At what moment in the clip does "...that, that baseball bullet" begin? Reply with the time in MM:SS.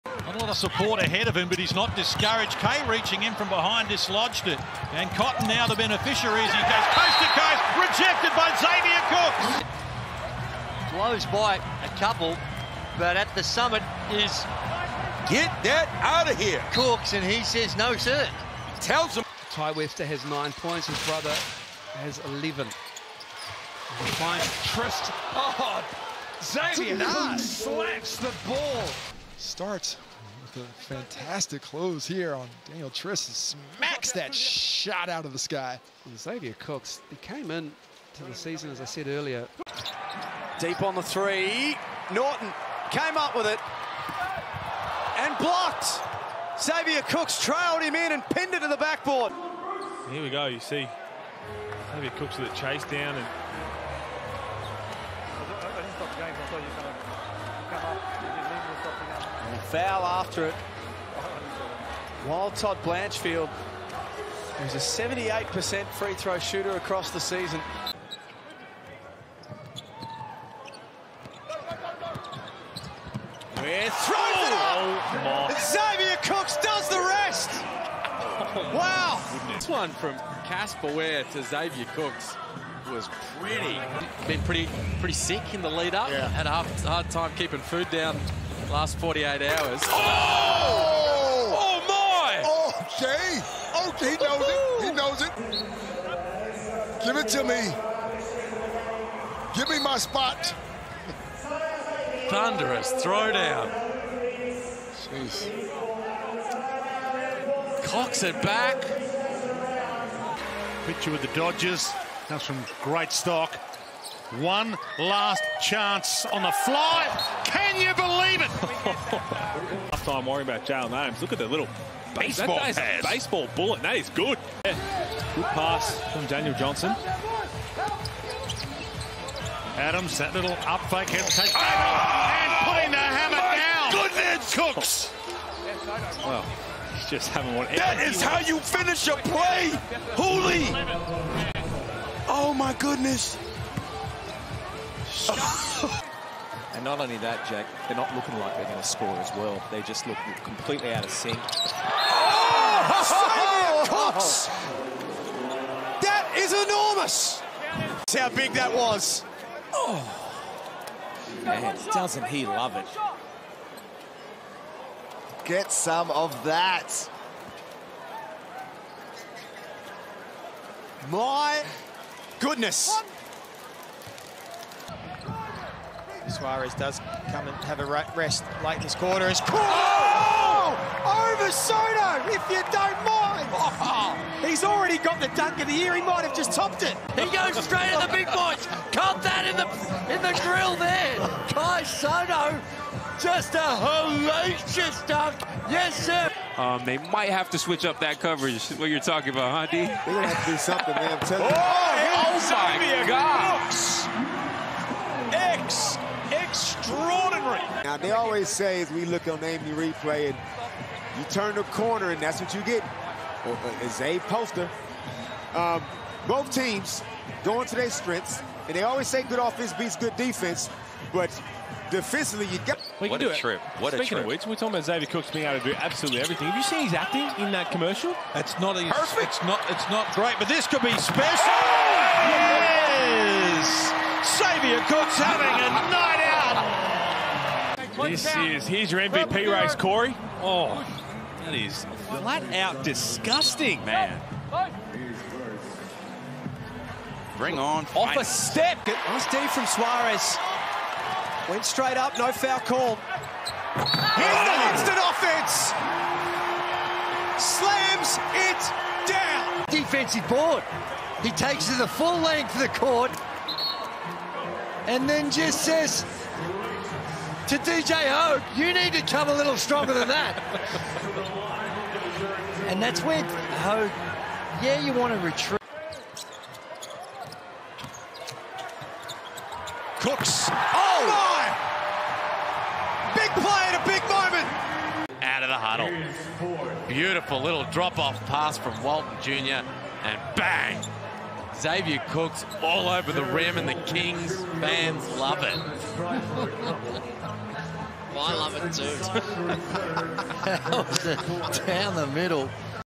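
02:02.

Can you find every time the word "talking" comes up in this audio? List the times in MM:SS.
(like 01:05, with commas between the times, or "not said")
03:18, 03:44.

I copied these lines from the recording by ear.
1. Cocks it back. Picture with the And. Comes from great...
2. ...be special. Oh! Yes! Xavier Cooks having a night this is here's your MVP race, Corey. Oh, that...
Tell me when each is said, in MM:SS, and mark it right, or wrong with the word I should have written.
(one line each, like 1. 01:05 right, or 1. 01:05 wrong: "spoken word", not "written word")
1. 01:47 wrong: "Dodgers", not "And"
2. 03:50 right.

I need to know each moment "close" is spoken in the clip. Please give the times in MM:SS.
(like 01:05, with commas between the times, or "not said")
00:10, 00:31.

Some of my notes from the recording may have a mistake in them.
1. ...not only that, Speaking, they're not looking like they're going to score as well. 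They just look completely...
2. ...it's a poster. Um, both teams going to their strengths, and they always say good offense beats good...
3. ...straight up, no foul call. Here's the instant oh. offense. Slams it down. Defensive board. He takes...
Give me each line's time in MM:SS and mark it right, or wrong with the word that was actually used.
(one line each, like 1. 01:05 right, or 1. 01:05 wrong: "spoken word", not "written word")
1. 02:26 wrong: "Jack", not "Speaking"
2. 03:33 right
3. 04:11 right.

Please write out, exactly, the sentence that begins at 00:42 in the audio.
Norton came up with it and blocked.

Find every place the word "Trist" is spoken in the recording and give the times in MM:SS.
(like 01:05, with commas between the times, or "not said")
00:24, 00:32.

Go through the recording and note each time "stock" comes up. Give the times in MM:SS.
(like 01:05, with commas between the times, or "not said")
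01:53.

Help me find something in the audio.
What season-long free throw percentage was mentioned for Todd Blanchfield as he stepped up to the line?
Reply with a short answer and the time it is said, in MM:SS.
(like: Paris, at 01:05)
78%, at 01:04.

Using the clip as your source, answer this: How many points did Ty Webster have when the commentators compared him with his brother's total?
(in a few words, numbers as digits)
9.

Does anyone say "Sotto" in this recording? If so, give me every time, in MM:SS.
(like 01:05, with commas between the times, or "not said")
03:01, 03:11.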